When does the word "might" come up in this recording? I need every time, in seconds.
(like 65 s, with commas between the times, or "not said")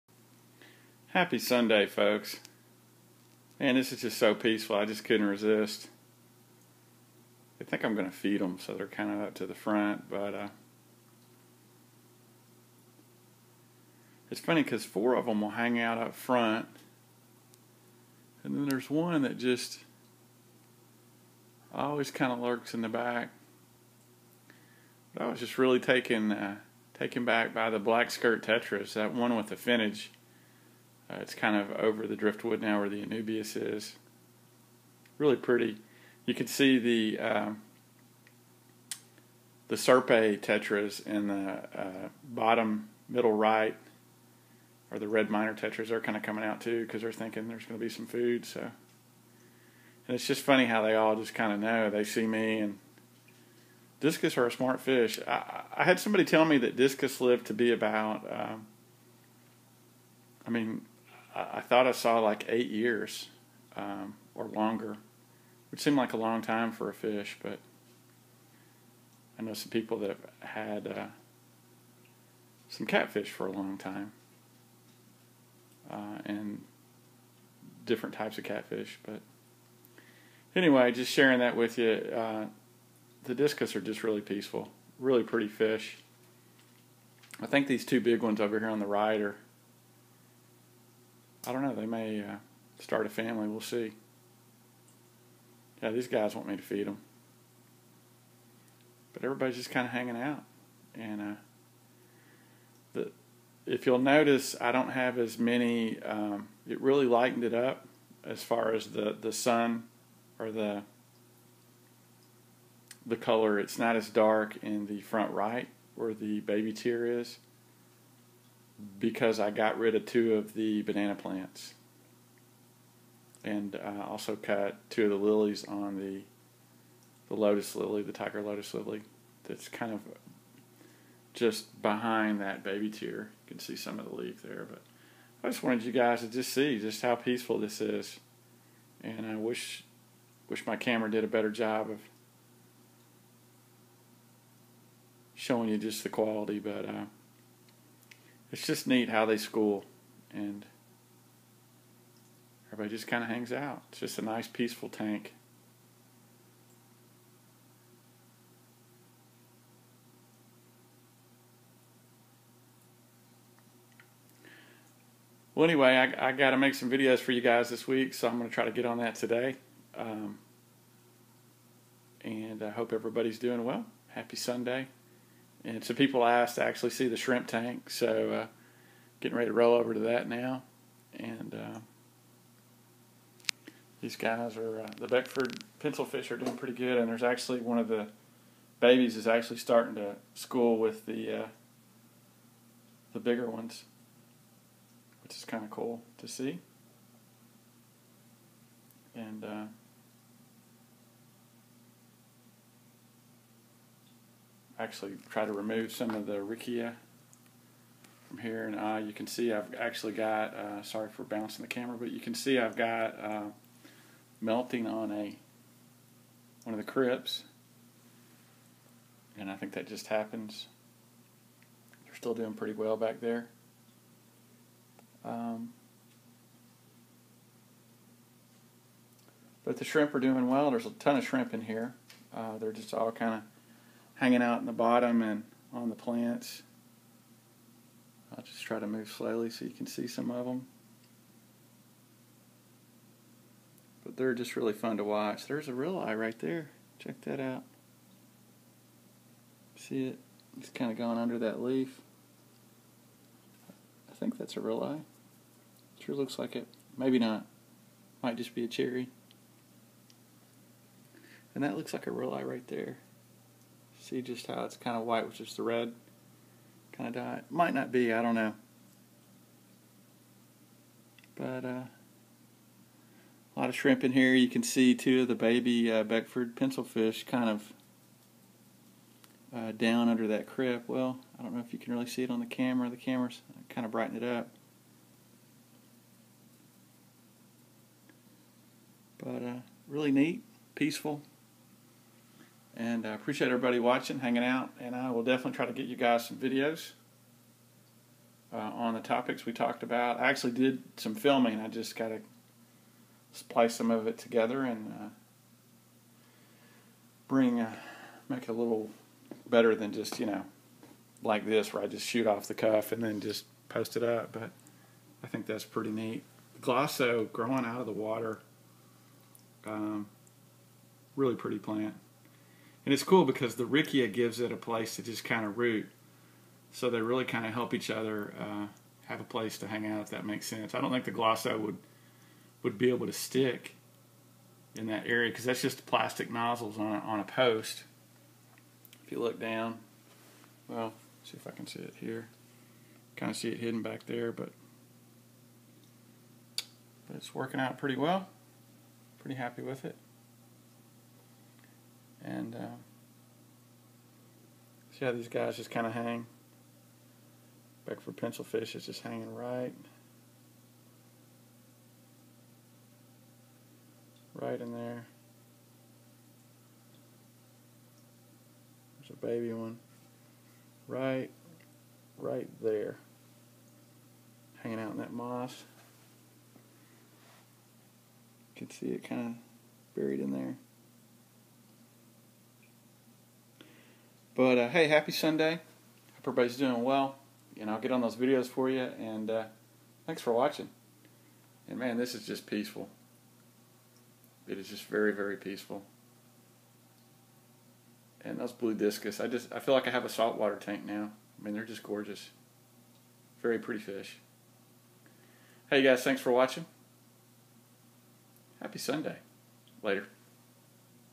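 258 s, 267 s.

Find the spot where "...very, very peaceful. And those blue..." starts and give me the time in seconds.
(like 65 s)
394 s.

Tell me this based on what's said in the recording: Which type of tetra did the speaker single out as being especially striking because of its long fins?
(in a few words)
Black skirt tetras.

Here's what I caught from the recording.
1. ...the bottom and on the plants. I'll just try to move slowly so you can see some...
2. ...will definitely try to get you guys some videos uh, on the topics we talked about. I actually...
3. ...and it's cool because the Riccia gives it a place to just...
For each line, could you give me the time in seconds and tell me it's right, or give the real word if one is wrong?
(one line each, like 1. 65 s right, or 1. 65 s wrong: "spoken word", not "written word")
1. 234 s right
2. 295 s right
3. 322 s right.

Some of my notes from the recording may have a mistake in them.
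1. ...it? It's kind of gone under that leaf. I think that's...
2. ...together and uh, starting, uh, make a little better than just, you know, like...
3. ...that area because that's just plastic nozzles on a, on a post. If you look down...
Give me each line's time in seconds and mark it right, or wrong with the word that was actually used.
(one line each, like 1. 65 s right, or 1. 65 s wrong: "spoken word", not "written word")
1. 250 s right
2. 304 s wrong: "bring", not "starting"
3. 334 s right.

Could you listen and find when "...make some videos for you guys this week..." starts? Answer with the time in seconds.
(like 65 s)
166 s.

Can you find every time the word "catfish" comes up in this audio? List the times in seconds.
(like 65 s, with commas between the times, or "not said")
72 s, 78 s.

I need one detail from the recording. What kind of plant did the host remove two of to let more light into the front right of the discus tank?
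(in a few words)
Banana plants.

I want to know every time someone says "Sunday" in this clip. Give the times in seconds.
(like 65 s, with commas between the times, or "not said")
1 s, 174 s, 385 s, 408 s.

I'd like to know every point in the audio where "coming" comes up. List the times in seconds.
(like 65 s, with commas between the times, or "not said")
46 s.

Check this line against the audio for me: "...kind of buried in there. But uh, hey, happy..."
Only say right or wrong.
right.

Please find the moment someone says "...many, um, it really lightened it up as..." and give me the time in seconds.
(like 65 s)
105 s.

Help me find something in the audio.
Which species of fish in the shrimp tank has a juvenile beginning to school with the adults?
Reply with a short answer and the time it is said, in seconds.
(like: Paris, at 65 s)
Beckford pencil fish, at 185 s.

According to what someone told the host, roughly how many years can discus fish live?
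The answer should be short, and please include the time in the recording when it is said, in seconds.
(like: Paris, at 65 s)
8 years, at 62 s.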